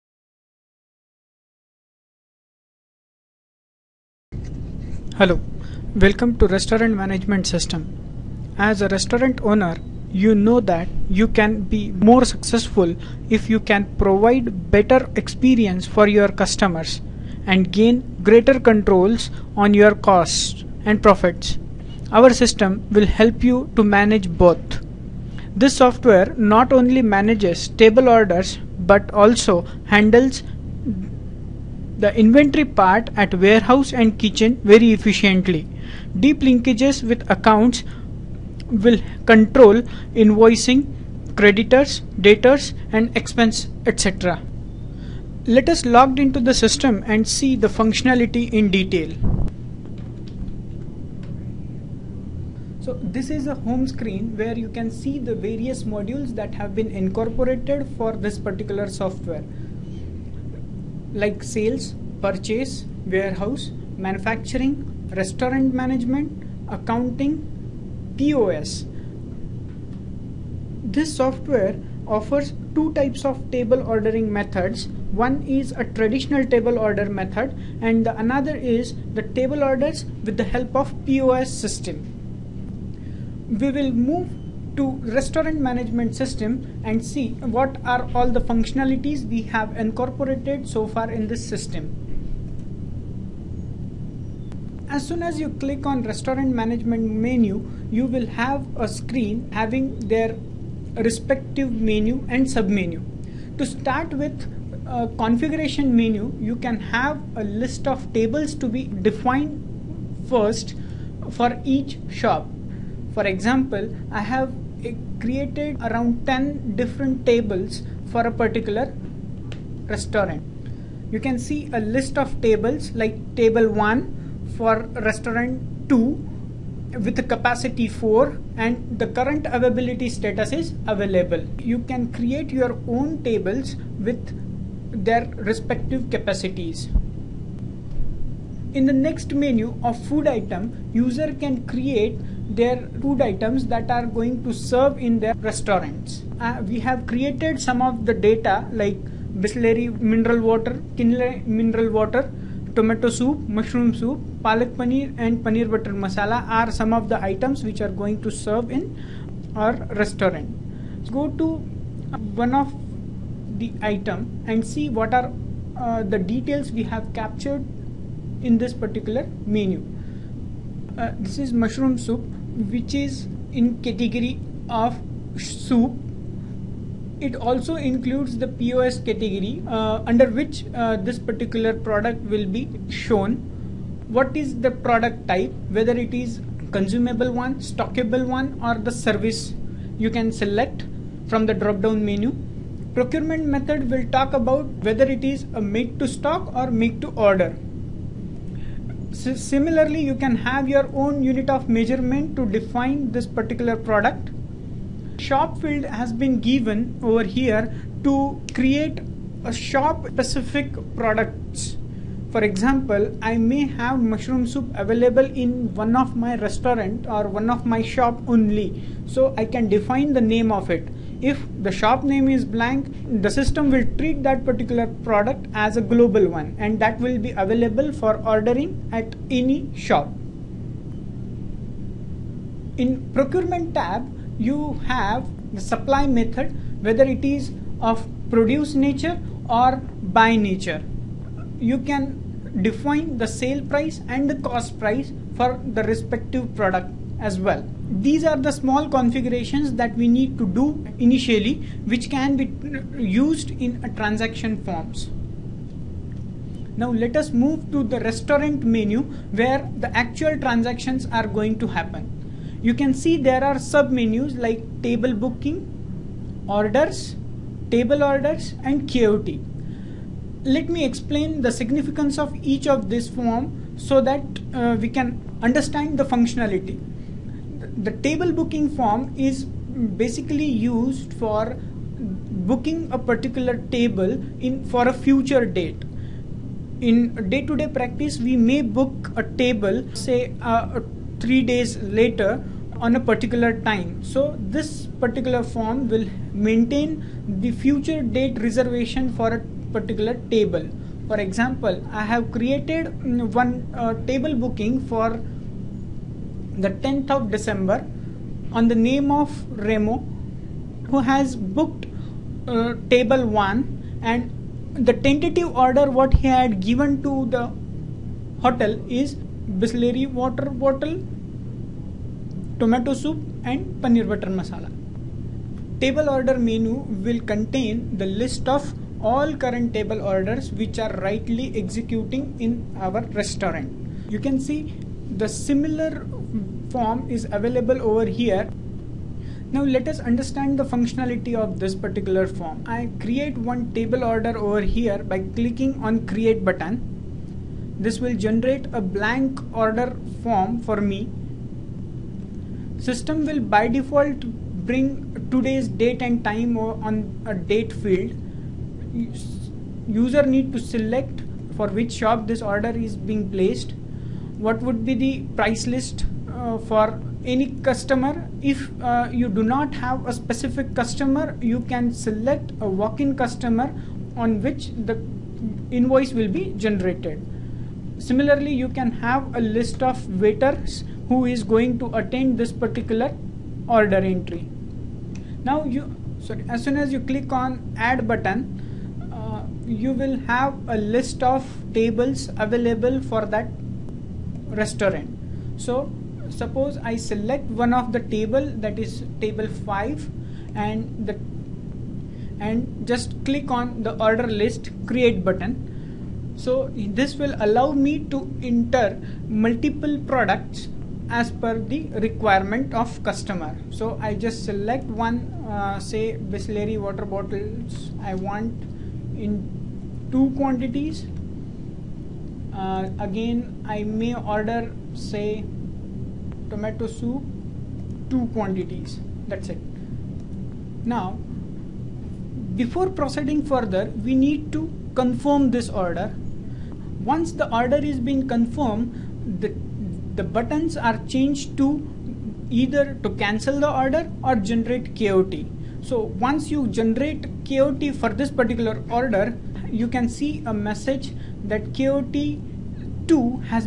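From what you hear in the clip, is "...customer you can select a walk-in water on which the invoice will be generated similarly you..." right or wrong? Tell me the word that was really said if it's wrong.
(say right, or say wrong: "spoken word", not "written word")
wrong: "customer", not "water".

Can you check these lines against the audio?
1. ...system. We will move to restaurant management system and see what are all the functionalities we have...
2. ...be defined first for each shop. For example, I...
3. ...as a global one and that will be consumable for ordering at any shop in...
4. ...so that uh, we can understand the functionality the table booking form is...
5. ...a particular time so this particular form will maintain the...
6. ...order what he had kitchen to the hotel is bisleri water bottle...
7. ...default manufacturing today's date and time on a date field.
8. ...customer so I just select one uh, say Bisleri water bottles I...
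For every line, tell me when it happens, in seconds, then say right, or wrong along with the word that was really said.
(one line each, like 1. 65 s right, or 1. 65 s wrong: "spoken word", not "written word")
1. 81 s right
2. 108 s right
3. 225 s wrong: "available", not "consumable"
4. 273 s right
5. 292 s right
6. 315 s wrong: "given", not "kitchen"
7. 353 s wrong: "bring", not "manufacturing"
8. 413 s right.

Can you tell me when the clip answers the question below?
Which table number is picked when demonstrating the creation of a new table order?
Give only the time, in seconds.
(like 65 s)
399 s.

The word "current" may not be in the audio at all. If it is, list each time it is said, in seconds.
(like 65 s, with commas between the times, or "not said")
129 s, 329 s.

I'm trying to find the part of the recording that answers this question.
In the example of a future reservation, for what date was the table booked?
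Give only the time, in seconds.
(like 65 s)
306 s.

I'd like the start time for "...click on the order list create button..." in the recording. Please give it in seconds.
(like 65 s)
403 s.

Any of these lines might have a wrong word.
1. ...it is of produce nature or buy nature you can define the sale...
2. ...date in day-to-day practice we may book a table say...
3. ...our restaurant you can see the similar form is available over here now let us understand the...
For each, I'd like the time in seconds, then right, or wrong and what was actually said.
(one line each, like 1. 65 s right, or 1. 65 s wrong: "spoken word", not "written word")
1. 237 s right
2. 285 s right
3. 332 s right.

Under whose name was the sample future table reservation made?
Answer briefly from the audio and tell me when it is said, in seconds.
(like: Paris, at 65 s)
Remo, at 309 s.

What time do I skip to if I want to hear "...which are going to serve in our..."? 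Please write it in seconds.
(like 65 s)
157 s.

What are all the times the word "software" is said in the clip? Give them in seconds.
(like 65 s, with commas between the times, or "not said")
25 s, 58 s, 71 s.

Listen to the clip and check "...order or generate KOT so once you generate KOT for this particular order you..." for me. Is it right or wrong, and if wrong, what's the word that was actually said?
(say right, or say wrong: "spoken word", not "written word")
right.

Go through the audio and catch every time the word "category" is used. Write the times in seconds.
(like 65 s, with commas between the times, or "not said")
173 s, 178 s.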